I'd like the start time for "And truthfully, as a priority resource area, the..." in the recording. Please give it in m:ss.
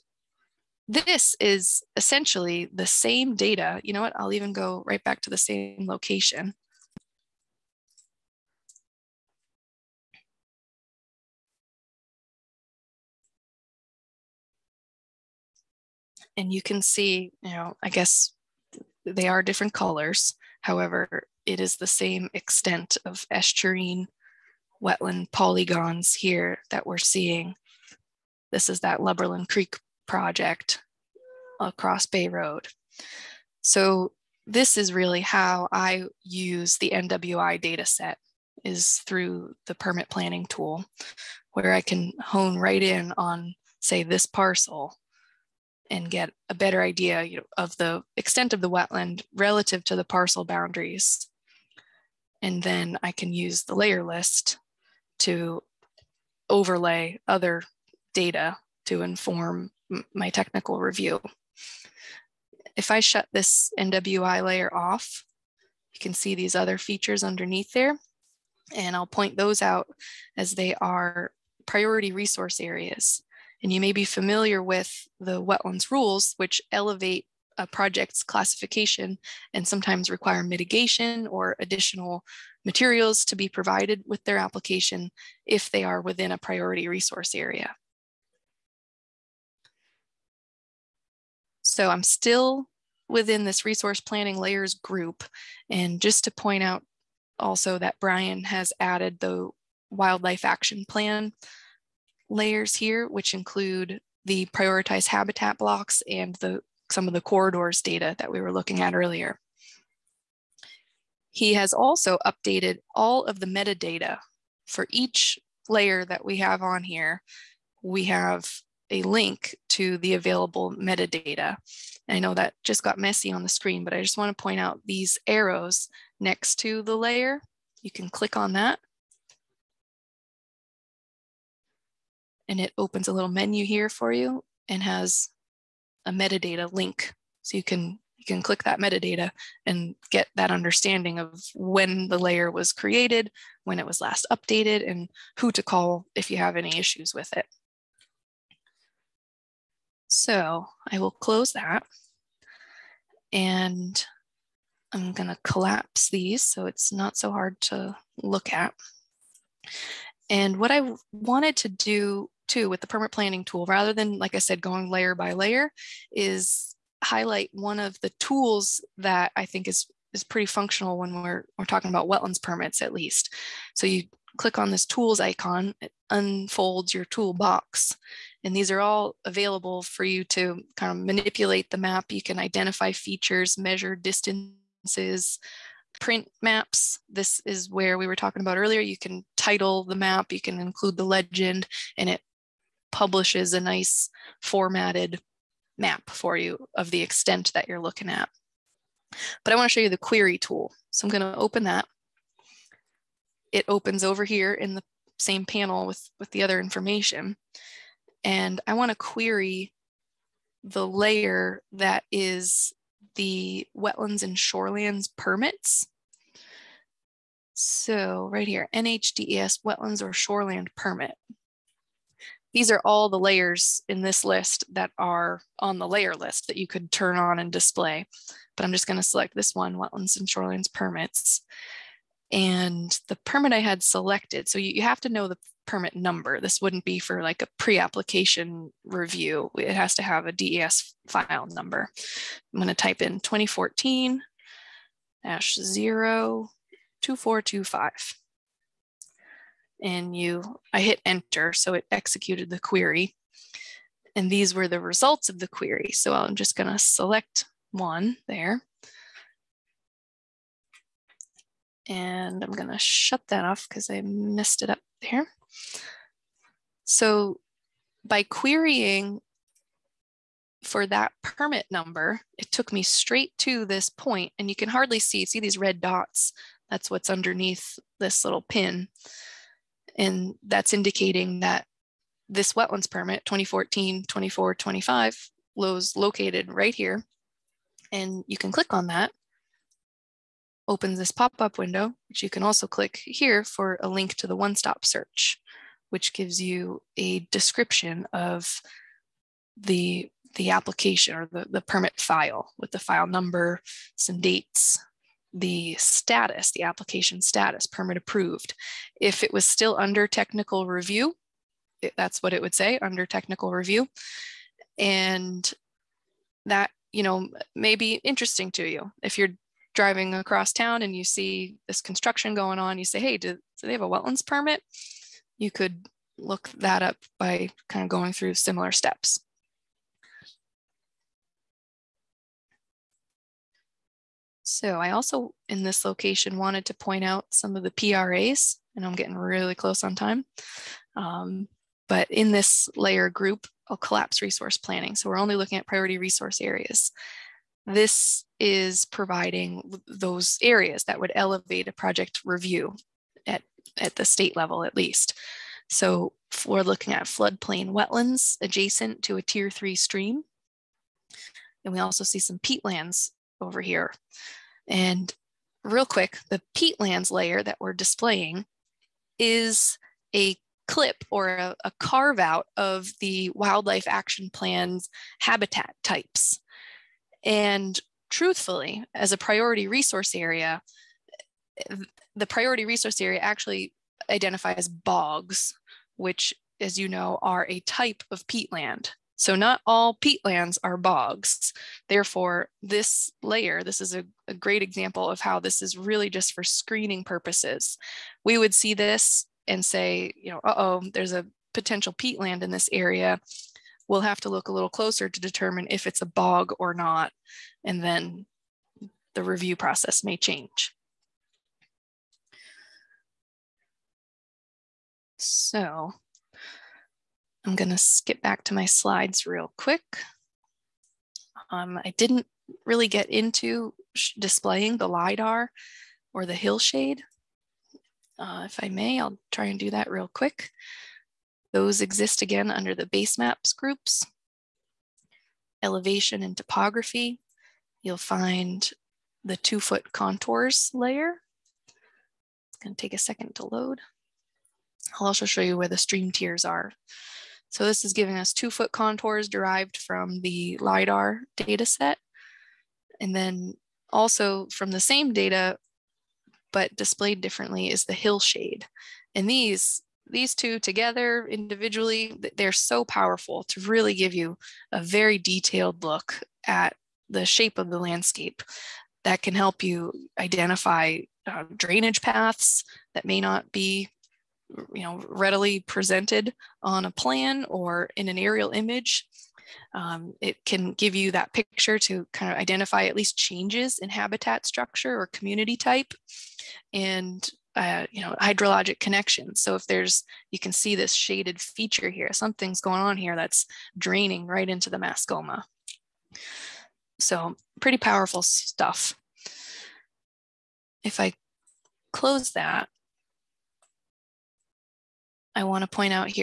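6:17.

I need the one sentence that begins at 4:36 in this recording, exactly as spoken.
That's what's underneath this little pin.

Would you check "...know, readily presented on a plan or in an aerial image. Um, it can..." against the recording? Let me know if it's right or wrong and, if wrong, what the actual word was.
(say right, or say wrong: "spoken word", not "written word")
right.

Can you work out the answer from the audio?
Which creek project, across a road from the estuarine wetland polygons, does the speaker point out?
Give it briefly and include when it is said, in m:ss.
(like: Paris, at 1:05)
Lubberland Creek, at 0:28.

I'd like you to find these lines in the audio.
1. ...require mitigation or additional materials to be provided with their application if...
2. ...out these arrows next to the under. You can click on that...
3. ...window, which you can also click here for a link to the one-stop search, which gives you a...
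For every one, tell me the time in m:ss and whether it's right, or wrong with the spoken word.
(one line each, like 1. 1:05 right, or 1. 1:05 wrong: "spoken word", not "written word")
1. 1:20 right
2. 2:04 wrong: "layer", not "under"
3. 4:51 right.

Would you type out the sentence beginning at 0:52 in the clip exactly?
And then I can use the layer list to overlay other data to inform my technical review.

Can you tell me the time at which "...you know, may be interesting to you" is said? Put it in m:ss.
5:16.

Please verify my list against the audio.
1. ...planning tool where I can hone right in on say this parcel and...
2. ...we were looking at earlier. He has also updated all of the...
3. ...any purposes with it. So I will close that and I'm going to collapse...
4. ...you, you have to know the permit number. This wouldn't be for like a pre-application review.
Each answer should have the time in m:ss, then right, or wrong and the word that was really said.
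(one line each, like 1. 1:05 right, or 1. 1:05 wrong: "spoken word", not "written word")
1. 0:40 right
2. 1:48 right
3. 2:26 wrong: "issues", not "purposes"
4. 3:54 right.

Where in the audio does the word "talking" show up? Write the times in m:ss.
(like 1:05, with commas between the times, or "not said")
2:51, 3:08.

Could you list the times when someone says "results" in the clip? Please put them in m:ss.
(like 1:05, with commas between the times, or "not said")
4:14.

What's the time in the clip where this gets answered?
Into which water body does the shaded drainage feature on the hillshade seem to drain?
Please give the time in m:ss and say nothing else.
8:14.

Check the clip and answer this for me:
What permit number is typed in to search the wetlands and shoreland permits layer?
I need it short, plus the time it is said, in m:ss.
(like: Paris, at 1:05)
2014-02425, at 4:03.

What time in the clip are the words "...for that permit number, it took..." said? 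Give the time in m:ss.
4:30.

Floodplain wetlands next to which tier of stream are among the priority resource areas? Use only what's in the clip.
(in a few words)
tier three.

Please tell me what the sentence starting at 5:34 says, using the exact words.
So I also, in this location, wanted to point out some of the PRAs, and I'm getting really close on time.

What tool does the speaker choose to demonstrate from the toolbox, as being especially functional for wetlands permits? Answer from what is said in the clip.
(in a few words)
query tool.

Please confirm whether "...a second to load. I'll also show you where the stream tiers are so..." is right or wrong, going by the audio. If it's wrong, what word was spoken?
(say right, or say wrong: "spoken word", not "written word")
right.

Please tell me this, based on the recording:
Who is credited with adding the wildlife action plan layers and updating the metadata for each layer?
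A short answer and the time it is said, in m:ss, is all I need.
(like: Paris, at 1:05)
Brian, at 1:37.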